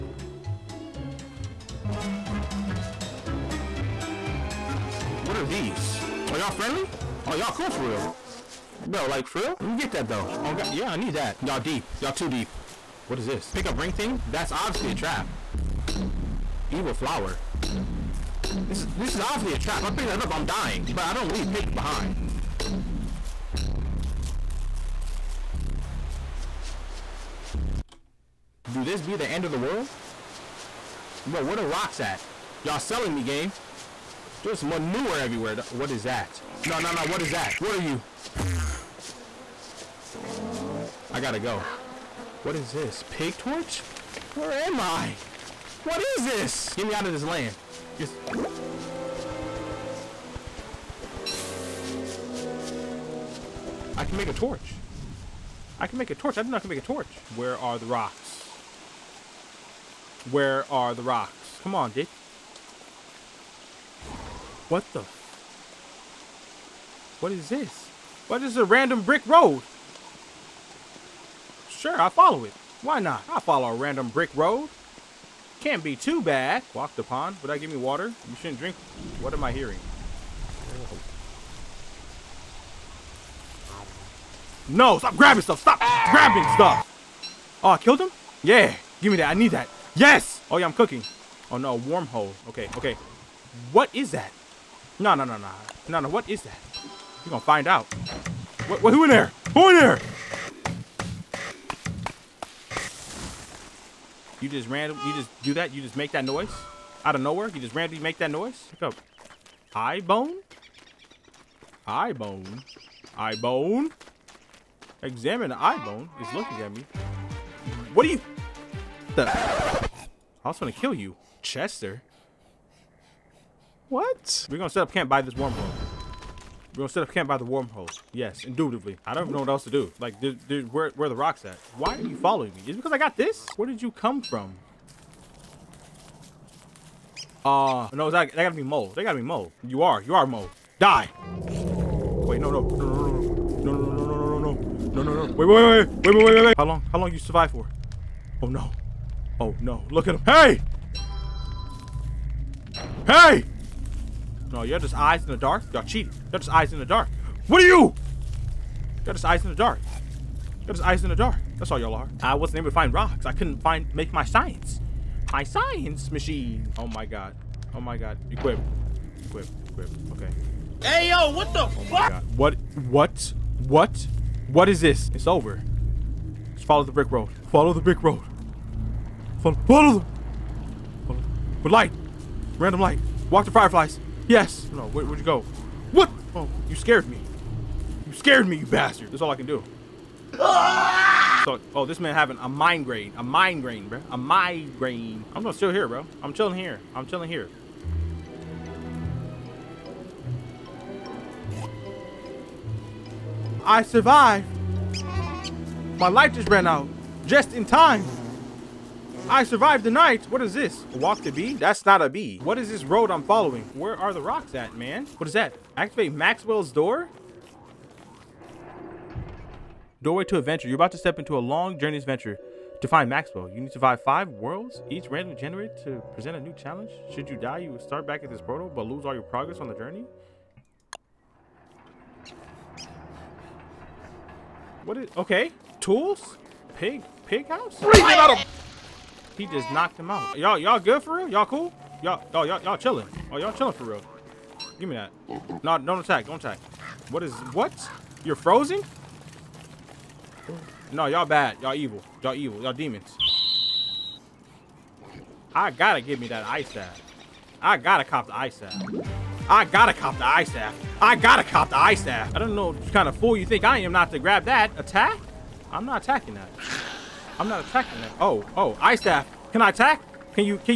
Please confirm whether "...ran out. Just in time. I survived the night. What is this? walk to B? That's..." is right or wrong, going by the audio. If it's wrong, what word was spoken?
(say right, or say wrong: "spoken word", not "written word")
right.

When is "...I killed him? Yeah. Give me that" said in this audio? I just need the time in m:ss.
1:27.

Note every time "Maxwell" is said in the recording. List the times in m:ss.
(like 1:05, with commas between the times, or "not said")
3:36, 3:43.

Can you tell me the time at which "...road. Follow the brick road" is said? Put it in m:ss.
2:57.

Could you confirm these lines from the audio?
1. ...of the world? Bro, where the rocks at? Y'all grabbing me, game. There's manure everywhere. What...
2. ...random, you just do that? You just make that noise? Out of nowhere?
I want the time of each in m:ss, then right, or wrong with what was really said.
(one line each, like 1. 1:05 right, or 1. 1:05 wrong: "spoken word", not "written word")
1. 0:29 wrong: "selling", not "grabbing"
2. 1:44 right.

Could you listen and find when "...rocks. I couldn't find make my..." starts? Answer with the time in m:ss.
2:42.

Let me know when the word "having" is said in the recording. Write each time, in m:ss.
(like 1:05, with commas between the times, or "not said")
3:12.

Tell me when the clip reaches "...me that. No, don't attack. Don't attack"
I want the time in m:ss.
4:04.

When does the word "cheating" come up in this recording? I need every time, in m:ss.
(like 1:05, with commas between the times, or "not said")
2:35.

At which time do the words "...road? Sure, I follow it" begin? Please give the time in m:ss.
1:09.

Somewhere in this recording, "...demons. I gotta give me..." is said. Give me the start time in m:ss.
4:12.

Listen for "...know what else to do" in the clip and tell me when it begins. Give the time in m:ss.
2:09.